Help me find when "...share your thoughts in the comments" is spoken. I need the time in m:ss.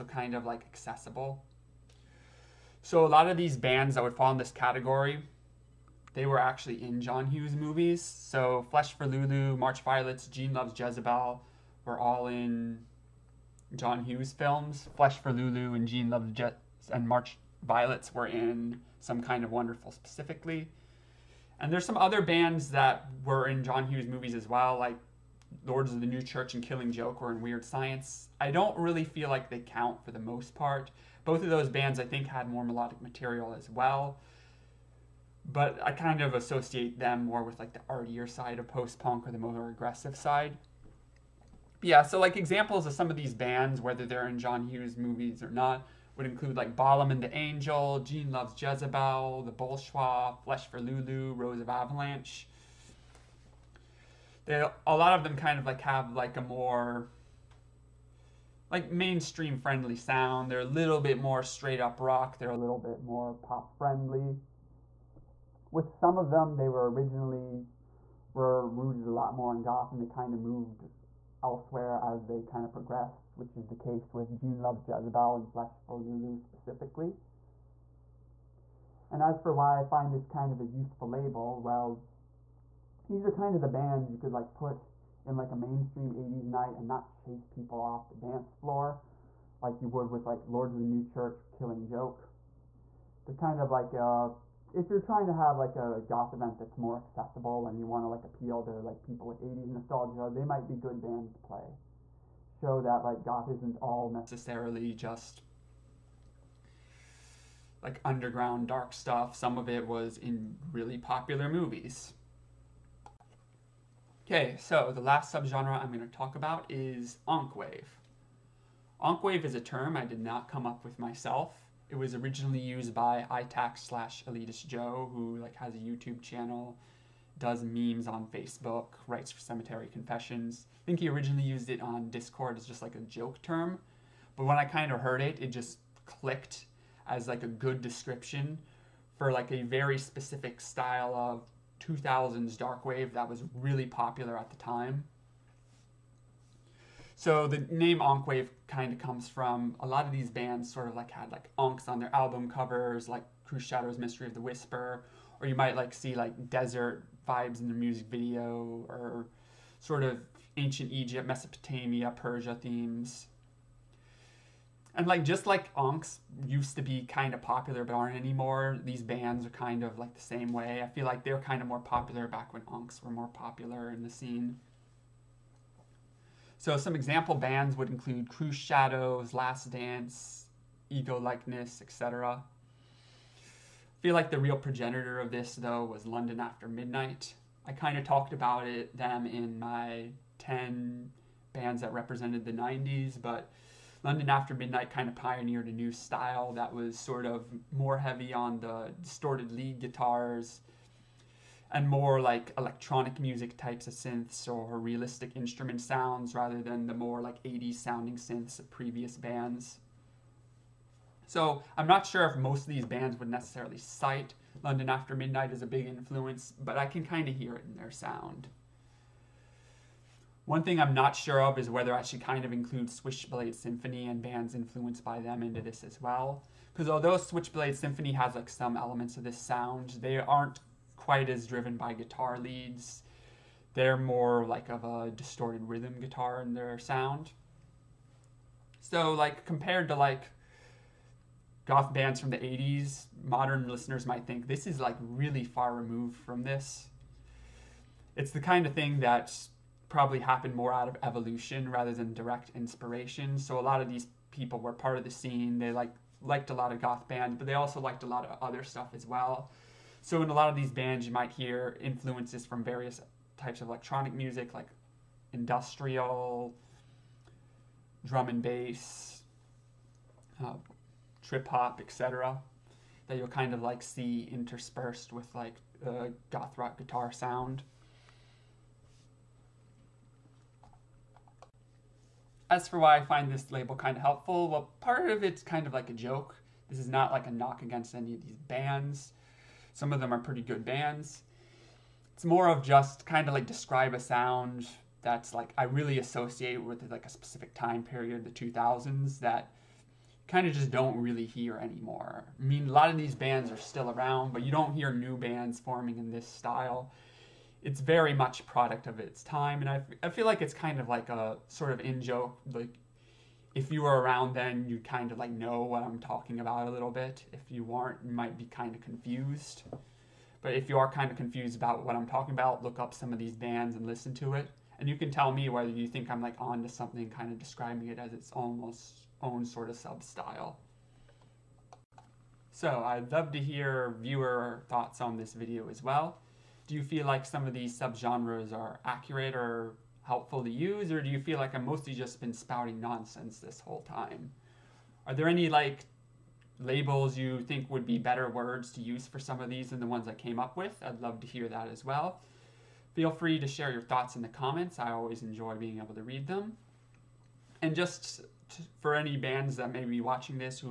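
5:53.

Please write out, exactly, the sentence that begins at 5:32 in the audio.
So I'd love to hear viewer thoughts on this video as well.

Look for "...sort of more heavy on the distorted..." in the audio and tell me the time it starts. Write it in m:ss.
3:16.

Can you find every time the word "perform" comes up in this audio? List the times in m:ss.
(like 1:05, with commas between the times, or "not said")
not said.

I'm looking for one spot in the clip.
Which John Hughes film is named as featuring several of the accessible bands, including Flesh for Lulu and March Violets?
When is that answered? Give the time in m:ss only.
0:18.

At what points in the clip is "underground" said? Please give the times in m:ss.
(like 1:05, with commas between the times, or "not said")
1:48.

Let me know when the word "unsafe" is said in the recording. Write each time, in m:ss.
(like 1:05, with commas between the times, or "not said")
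not said.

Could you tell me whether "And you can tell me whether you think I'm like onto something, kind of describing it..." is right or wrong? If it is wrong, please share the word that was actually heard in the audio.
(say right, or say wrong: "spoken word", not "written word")
right.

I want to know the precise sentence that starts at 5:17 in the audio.
If you aren't, you might be kind of confused.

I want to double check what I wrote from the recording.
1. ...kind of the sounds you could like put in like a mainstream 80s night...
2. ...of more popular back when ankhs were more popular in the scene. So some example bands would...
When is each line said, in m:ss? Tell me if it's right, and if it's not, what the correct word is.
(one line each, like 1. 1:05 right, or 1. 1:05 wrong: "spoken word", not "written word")
1. 1:23 wrong: "bands", not "sounds"
2. 2:51 right.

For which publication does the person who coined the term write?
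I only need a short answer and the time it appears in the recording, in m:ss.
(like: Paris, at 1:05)
Cemetery Confessions, at 2:09.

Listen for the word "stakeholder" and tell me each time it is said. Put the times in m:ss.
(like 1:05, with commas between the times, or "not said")
not said.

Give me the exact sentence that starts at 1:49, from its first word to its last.
Some of it was in really popular movies.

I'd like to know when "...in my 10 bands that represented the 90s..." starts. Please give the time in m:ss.
3:09.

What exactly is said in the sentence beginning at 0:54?
They, a lot of them kind of like have like a more like mainstream friendly sound.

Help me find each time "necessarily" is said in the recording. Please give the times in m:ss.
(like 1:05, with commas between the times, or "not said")
1:44, 3:33.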